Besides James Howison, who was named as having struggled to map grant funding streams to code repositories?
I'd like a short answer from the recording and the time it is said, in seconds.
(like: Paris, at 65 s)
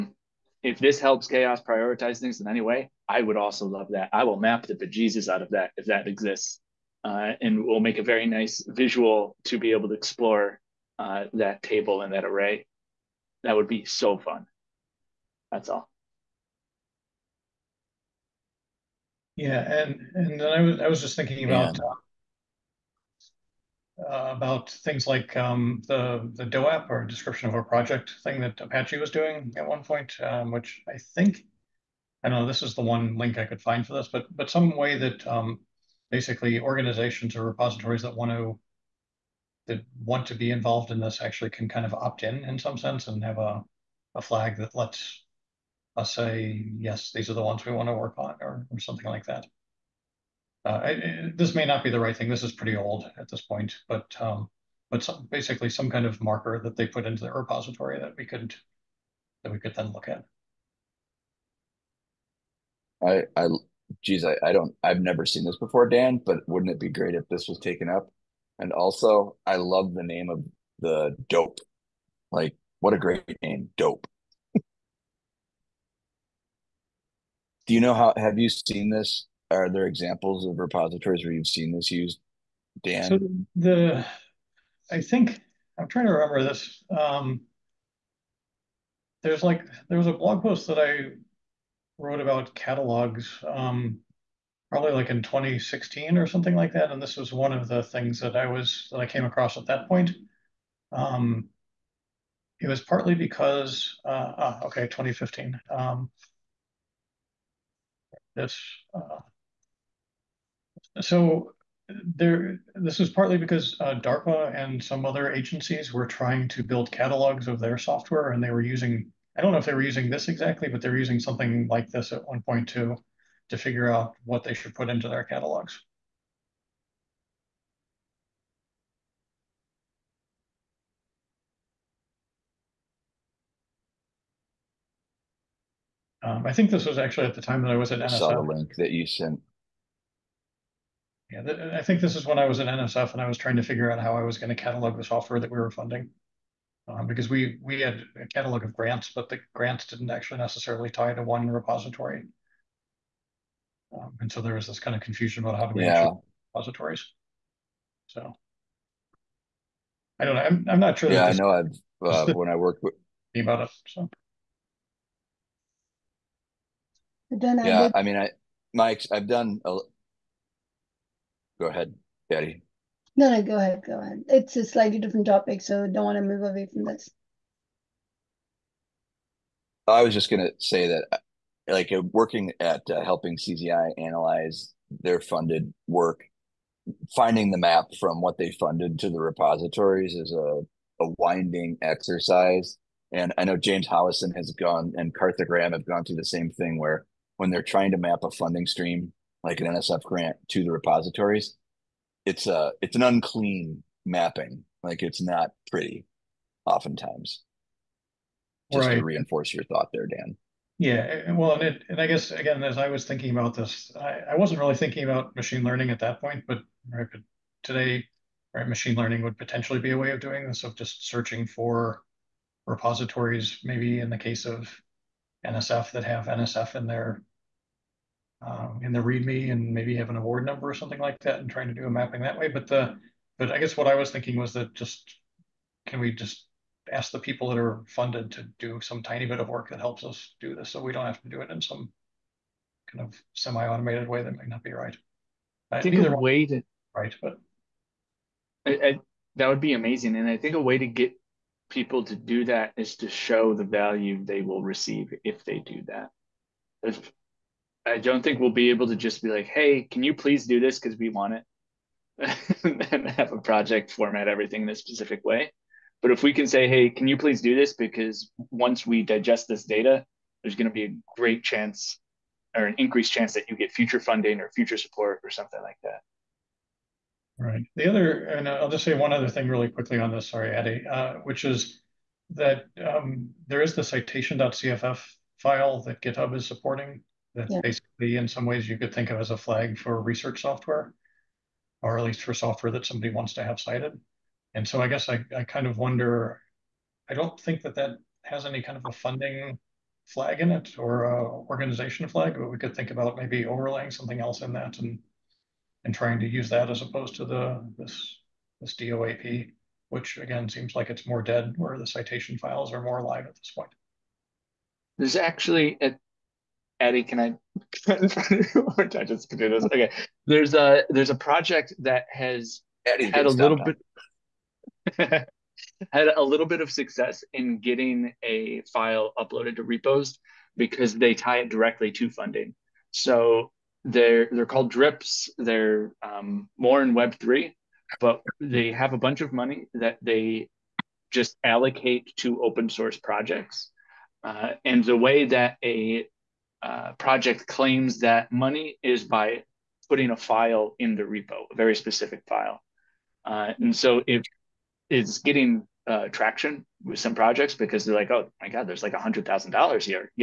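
Karthik Ram, at 195 s.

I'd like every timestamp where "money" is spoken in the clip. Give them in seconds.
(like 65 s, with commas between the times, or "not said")
339 s, 348 s.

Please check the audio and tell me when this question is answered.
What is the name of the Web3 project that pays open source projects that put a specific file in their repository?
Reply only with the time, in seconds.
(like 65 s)
334 s.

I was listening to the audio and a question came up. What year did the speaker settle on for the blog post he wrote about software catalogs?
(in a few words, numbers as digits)
2015.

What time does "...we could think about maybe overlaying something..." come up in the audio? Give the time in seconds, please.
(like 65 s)
302 s.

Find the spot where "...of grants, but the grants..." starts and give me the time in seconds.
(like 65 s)
148 s.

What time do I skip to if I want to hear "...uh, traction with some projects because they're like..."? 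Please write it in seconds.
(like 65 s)
355 s.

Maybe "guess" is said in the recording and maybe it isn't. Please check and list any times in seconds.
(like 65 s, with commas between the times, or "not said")
212 s, 233 s, 294 s.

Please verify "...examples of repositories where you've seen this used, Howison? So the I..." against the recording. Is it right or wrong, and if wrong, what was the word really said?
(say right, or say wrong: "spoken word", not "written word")
wrong: "Dan", not "Howison".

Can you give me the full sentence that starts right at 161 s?
I've uh, when I worked with about it.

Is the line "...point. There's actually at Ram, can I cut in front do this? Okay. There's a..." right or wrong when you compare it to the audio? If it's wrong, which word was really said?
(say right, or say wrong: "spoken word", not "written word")
wrong: "Eddie", not "Ram".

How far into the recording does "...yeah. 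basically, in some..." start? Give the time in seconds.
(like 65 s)
287 s.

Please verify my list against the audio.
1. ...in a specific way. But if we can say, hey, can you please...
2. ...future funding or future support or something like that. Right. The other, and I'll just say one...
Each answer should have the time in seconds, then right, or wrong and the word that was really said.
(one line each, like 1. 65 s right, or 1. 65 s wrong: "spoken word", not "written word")
1. 264 s right
2. 273 s right.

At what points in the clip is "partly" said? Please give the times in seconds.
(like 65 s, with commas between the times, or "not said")
102 s, 113 s.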